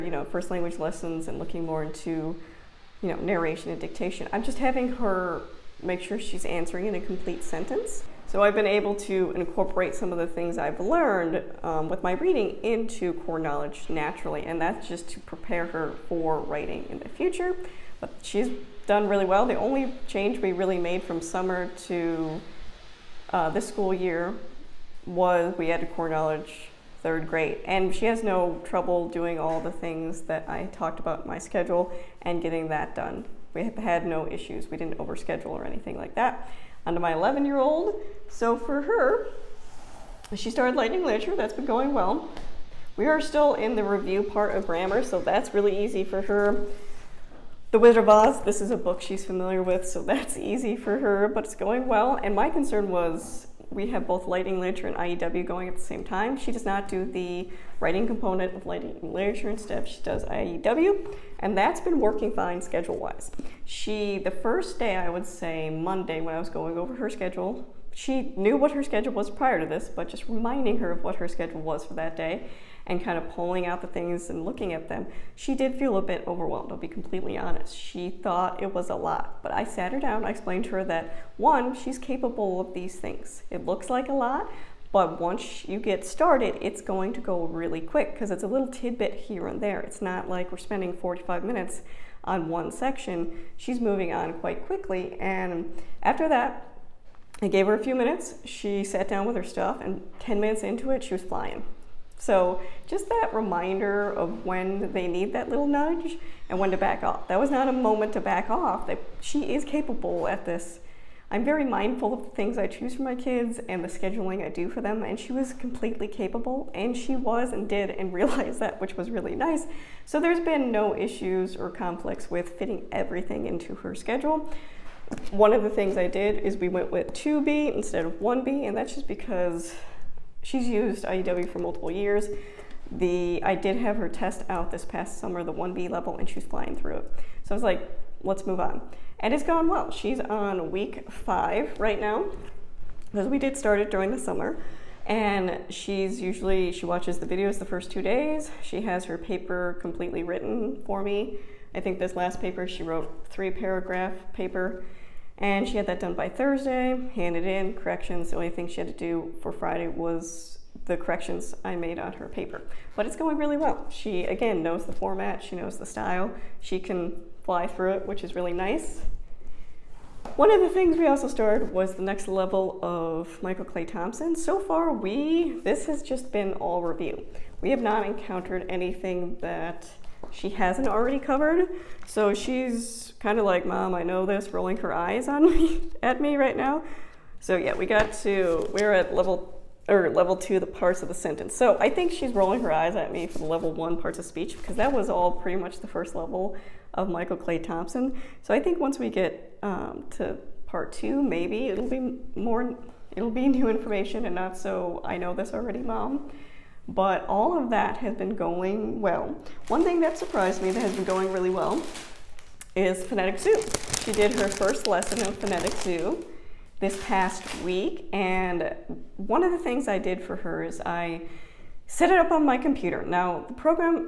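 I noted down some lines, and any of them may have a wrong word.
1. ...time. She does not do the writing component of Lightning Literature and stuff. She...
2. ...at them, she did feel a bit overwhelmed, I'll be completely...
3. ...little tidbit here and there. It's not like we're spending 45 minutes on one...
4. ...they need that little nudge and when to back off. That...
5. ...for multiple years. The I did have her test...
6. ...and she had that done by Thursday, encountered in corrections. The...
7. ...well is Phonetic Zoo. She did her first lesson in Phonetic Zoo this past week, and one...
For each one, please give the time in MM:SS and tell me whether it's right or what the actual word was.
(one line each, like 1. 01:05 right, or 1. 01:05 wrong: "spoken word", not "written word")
1. 00:56 right
2. 01:14 right
3. 01:28 right
4. 01:44 right
5. 02:11 right
6. 02:35 wrong: "handed", not "encountered"
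7. 03:31 right.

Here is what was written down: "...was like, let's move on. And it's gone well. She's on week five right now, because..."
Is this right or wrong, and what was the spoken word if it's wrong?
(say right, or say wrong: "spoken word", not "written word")
right.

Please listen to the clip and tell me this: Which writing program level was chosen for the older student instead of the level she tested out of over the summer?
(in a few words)
2B.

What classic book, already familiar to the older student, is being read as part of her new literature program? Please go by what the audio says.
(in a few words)
The Wizard of Oz.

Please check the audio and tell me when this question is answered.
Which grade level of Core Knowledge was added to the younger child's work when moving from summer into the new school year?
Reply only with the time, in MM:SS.
00:27.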